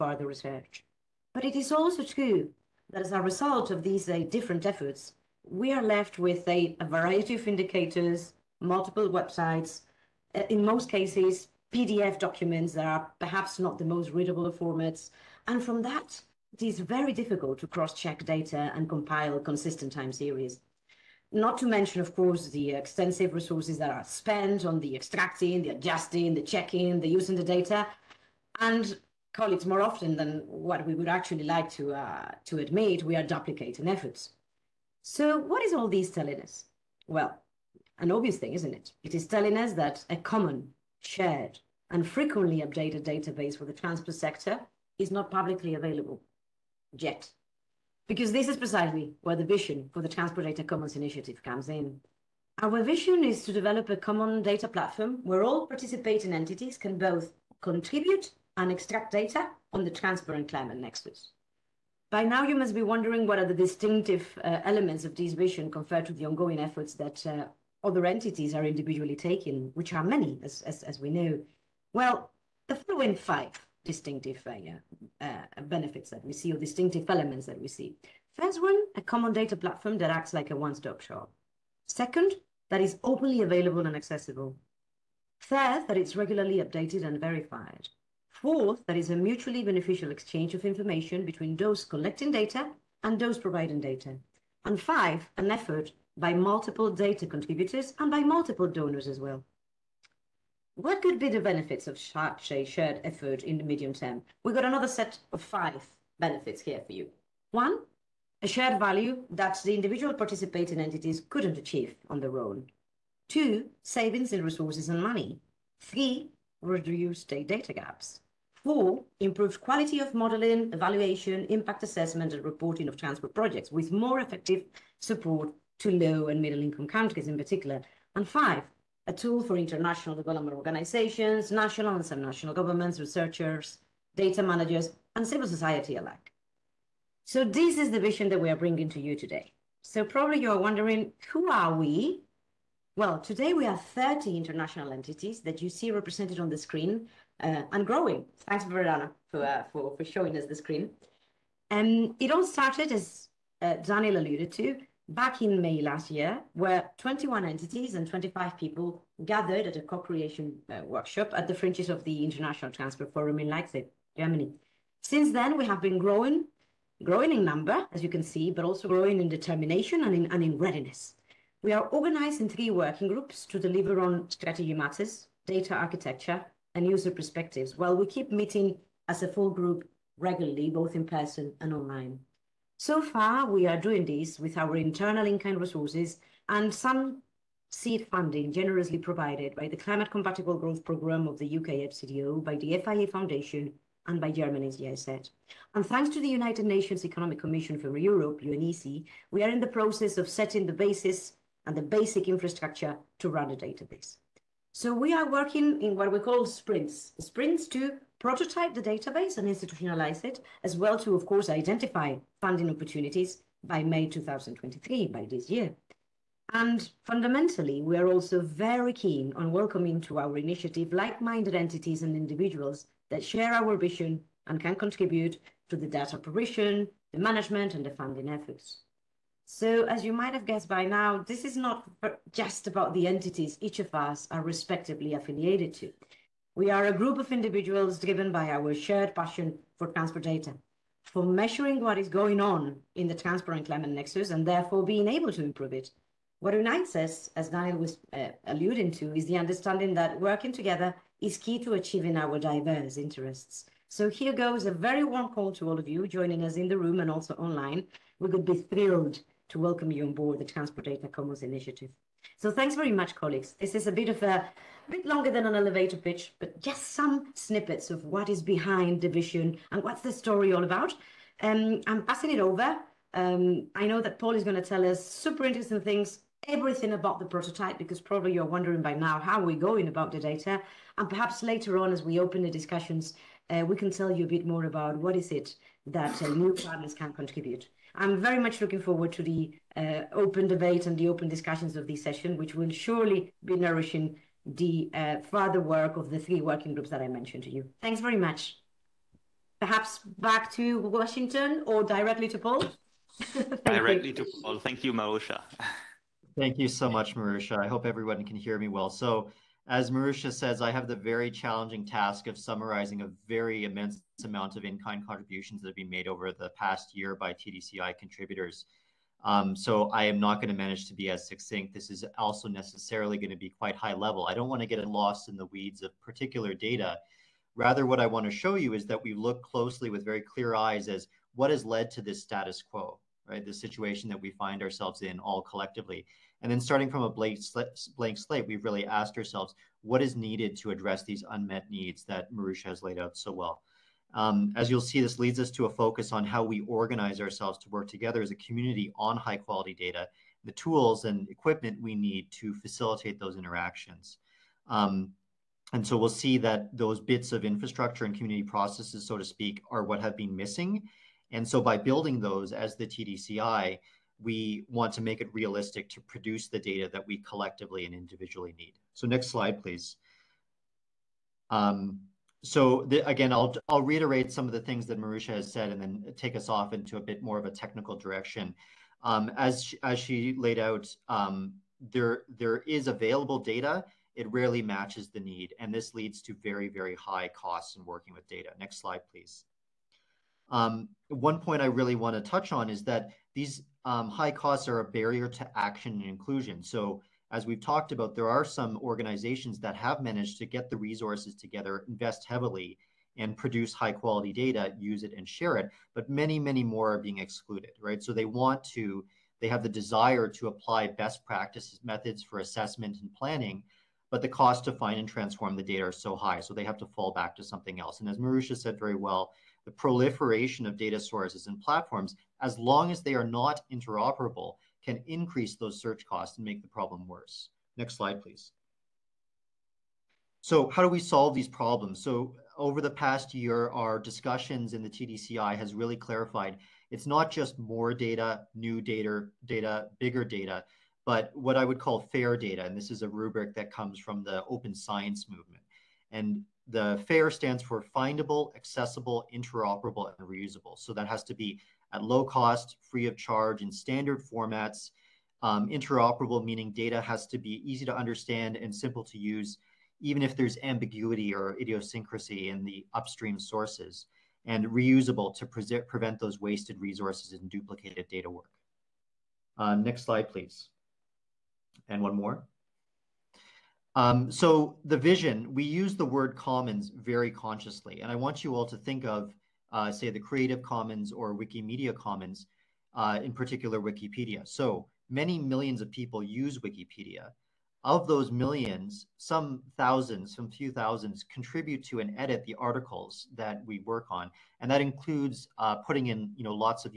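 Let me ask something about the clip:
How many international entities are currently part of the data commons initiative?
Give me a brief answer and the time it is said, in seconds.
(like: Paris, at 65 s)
30, at 143 s.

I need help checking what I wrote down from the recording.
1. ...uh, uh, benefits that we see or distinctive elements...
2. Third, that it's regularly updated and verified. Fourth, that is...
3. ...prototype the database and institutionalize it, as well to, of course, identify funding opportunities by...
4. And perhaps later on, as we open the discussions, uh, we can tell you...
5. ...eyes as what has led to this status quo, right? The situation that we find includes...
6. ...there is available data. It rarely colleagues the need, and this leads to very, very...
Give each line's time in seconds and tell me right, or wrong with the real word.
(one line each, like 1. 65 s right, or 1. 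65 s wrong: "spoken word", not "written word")
1. 75 s right
2. 85 s right
3. 208 s right
4. 280 s right
5. 330 s wrong: "ourselves", not "includes"
6. 382 s wrong: "matches", not "colleagues".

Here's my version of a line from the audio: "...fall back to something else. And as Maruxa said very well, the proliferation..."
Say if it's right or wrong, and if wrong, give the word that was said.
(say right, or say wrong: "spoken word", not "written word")
right.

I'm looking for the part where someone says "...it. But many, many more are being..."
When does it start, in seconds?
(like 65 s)
405 s.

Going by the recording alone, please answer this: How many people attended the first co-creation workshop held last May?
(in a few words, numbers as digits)
25.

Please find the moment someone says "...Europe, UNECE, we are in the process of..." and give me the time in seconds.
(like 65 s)
197 s.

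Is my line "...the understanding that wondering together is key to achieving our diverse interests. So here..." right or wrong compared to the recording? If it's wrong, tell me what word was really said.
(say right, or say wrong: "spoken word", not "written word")
wrong: "working", not "wondering".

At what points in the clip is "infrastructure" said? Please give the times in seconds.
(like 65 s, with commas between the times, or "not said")
202 s, 357 s.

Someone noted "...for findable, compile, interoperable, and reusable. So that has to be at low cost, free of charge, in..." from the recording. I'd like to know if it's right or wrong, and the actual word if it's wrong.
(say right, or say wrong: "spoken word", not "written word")
wrong: "accessible", not "compile".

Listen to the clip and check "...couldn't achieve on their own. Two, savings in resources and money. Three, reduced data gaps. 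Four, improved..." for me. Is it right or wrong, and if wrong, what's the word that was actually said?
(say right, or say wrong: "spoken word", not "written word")
right.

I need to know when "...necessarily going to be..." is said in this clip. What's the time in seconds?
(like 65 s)
322 s.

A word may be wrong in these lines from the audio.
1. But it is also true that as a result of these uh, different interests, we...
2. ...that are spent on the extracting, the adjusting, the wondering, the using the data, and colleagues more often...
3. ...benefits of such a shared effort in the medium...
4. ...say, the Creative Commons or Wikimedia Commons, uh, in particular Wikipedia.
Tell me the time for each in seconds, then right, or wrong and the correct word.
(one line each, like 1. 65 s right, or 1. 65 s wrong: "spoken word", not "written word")
1. 1 s wrong: "efforts", not "interests"
2. 23 s wrong: "checking", not "wondering"
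3. 101 s right
4. 479 s right.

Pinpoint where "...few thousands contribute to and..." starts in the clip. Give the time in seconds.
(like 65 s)
490 s.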